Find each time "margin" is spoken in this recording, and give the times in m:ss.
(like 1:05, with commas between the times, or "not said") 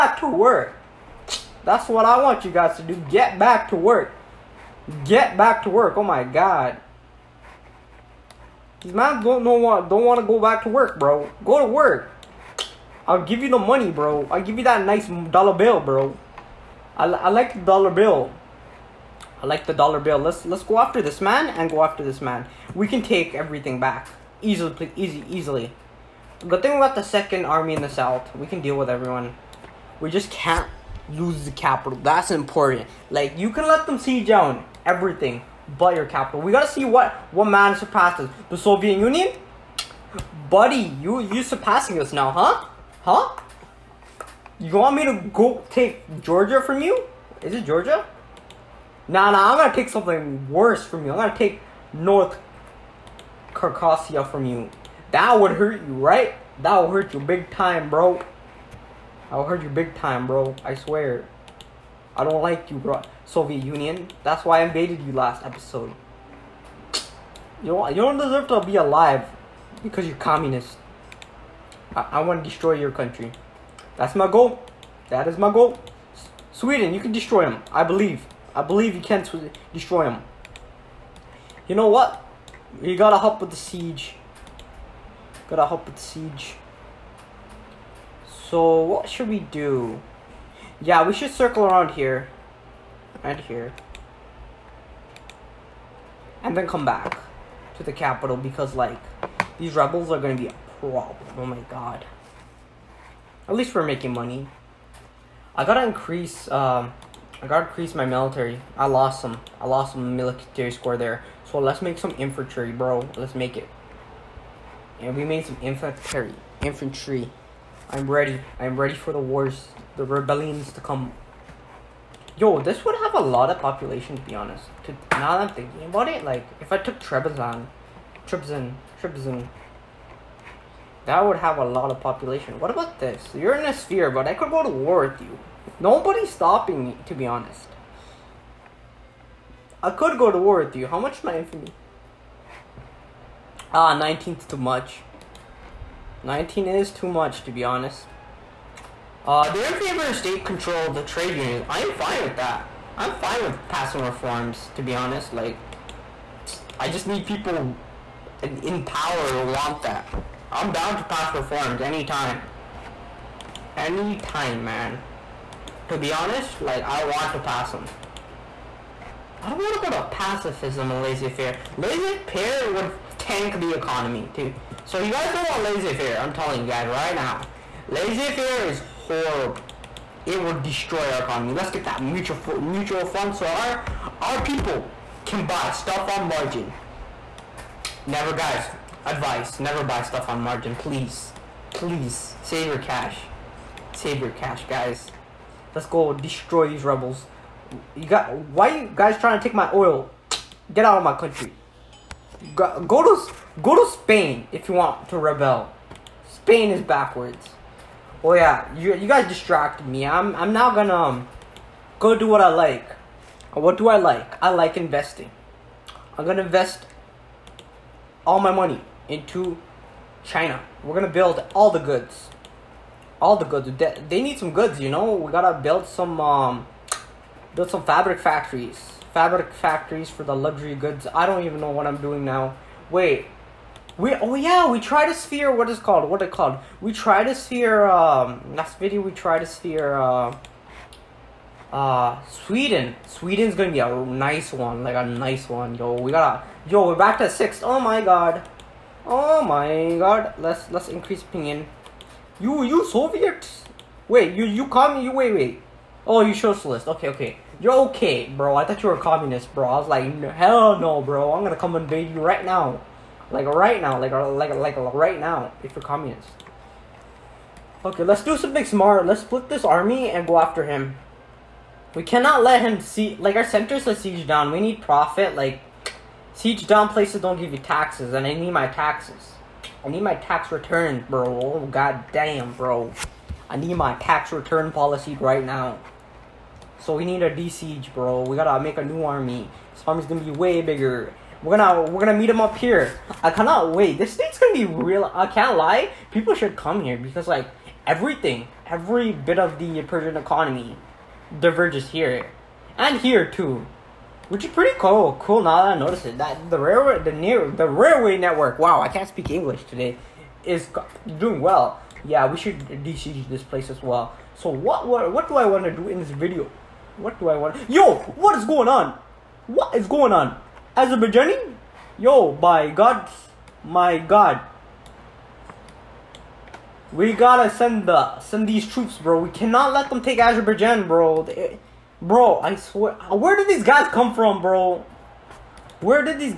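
3:06, 3:10.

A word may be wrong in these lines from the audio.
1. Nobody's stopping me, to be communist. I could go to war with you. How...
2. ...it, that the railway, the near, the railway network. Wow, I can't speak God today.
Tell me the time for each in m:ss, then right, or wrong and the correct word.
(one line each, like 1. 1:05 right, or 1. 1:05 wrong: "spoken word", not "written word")
1. 2:15 wrong: "honest", not "communist"
2. 5:06 wrong: "English", not "God".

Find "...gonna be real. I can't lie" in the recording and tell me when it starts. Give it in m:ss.
4:54.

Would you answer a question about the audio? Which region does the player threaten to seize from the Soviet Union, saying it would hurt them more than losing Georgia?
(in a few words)
North Carcassia.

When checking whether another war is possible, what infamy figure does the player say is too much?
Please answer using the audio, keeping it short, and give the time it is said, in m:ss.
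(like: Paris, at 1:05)
19, at 2:26.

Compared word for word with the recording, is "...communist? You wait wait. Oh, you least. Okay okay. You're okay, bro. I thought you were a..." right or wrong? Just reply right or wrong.
wrong.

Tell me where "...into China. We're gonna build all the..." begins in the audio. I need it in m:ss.
3:39.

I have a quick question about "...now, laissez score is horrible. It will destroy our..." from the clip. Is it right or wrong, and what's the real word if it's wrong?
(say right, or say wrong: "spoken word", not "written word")
wrong: "faire", not "score".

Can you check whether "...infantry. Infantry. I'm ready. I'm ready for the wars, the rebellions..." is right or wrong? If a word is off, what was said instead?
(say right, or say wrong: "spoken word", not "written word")
right.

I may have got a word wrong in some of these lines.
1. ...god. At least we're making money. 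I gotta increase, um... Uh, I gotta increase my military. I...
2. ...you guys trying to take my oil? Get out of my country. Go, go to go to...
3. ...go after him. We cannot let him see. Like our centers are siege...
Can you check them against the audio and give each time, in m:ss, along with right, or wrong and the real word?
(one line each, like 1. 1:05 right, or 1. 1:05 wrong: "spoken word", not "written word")
1. 1:41 right
2. 3:18 right
3. 4:30 right.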